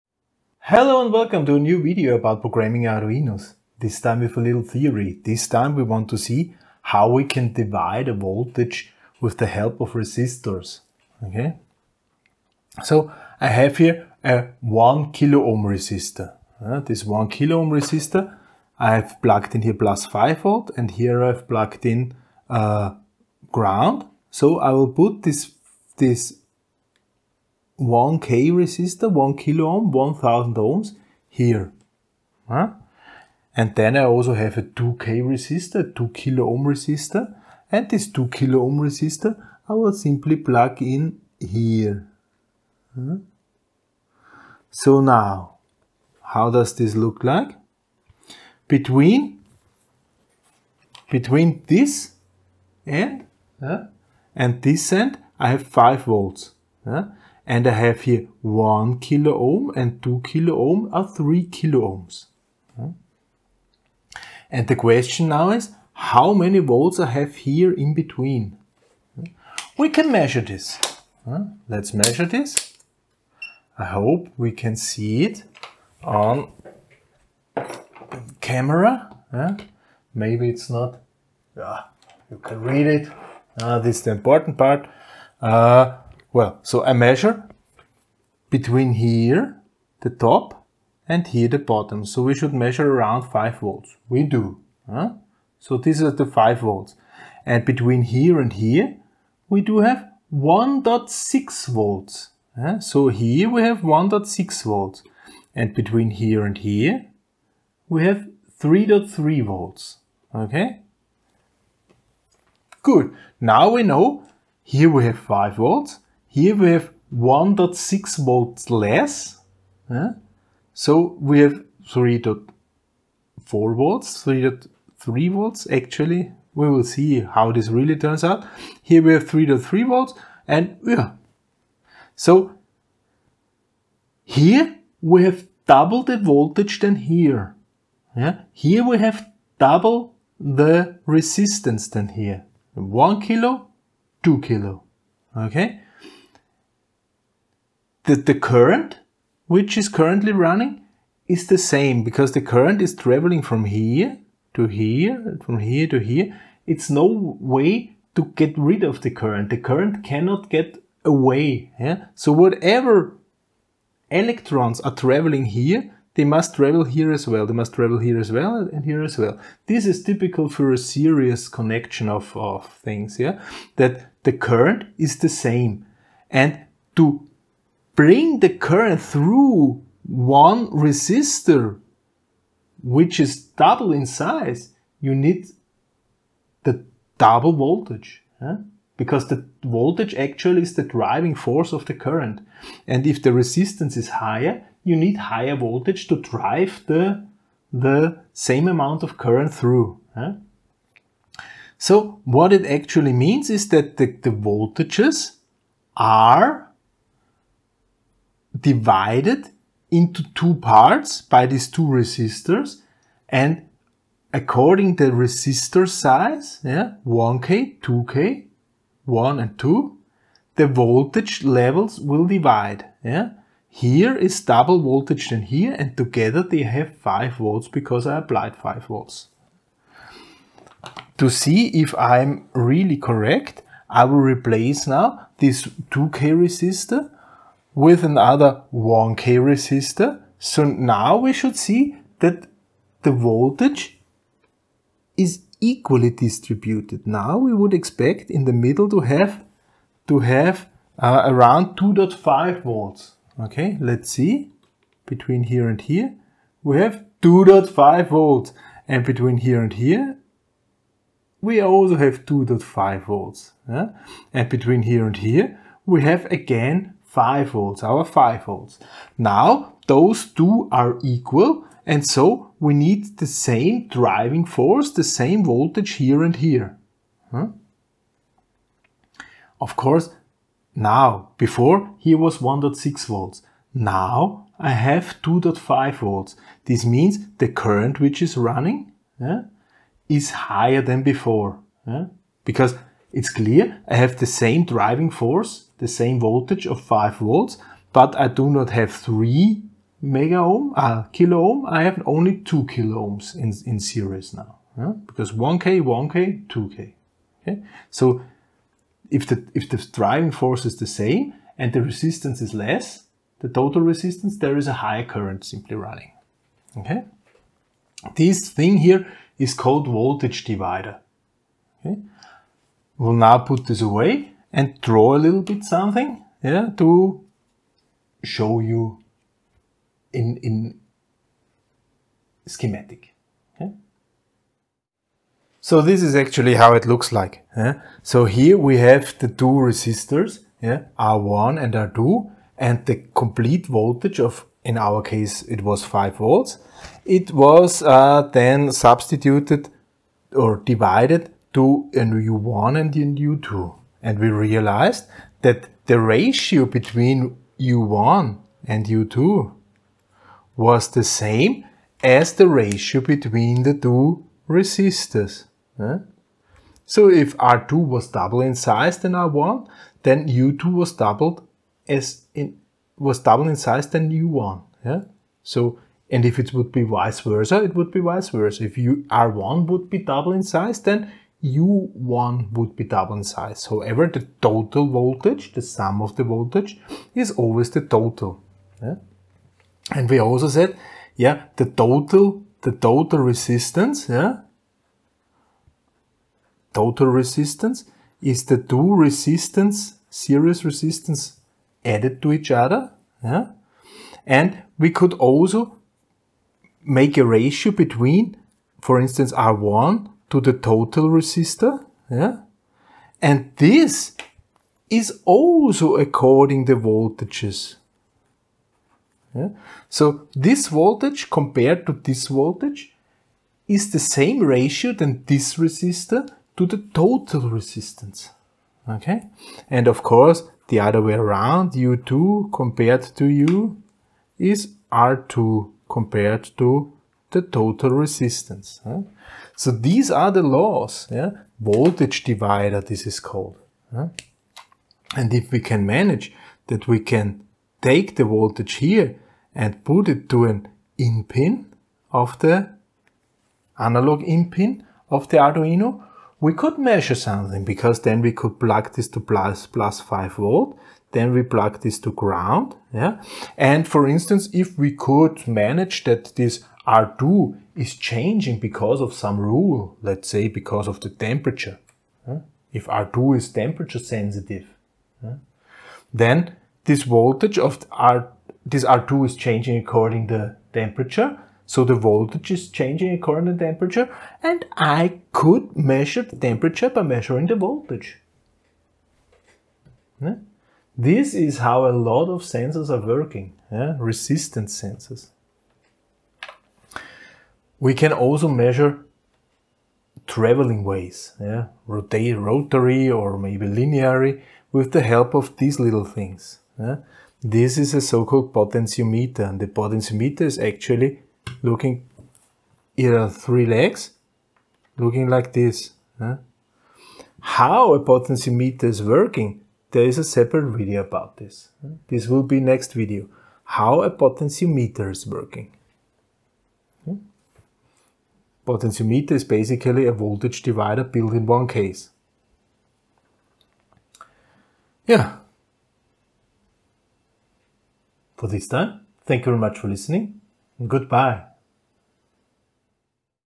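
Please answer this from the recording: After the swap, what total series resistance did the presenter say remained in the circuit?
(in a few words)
2 kilo ohms.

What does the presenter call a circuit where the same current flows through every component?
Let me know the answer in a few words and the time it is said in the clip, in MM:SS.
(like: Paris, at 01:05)
serious connection, at 02:50.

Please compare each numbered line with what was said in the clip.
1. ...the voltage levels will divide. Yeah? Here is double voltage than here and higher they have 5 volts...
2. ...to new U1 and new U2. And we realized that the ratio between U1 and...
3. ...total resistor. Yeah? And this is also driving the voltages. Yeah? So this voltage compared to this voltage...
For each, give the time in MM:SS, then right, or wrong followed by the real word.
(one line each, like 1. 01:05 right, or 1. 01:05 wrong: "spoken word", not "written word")
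1. 03:40 wrong: "together", not "higher"
2. 05:51 right
3. 06:50 wrong: "according", not "driving".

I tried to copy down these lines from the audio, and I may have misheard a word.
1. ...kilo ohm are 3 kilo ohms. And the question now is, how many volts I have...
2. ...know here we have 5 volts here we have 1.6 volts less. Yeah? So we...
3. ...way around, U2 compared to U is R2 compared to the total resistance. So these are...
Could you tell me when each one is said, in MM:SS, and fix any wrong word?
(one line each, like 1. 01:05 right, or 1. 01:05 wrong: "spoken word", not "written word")
1. 01:00 right
2. 01:53 right
3. 07:11 right.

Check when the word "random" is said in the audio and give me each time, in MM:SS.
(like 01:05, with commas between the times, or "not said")
not said.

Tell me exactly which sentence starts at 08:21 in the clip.
rotary or maybe linear, with the help of these little things.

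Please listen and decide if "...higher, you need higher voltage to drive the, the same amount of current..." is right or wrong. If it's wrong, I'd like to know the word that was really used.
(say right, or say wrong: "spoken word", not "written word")
right.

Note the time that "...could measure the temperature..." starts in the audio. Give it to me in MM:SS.
08:05.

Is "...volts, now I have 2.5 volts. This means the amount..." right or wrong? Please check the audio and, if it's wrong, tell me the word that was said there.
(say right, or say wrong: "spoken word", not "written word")
wrong: "current", not "amount".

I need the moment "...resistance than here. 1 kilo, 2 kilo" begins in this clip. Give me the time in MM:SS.
02:21.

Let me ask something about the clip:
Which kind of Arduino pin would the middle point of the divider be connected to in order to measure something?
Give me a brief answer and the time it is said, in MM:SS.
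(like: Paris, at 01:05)
analog in pin, at 07:33.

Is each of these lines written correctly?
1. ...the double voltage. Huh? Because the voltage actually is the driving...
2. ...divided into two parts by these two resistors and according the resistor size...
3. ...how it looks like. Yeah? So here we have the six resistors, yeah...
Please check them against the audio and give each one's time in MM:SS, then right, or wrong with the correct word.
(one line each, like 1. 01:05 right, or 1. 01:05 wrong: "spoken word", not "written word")
1. 03:06 right
2. 03:28 right
3. 05:36 wrong: "two", not "six".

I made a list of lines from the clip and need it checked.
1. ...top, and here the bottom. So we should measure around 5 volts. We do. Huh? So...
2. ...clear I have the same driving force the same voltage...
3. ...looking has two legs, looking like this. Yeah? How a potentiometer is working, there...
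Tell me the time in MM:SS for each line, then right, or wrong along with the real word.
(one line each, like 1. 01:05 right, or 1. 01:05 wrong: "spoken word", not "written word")
1. 01:30 right
2. 04:53 right
3. 08:31 wrong: "three", not "two".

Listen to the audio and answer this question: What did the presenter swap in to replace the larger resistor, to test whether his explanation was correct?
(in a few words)
another 1K resistor.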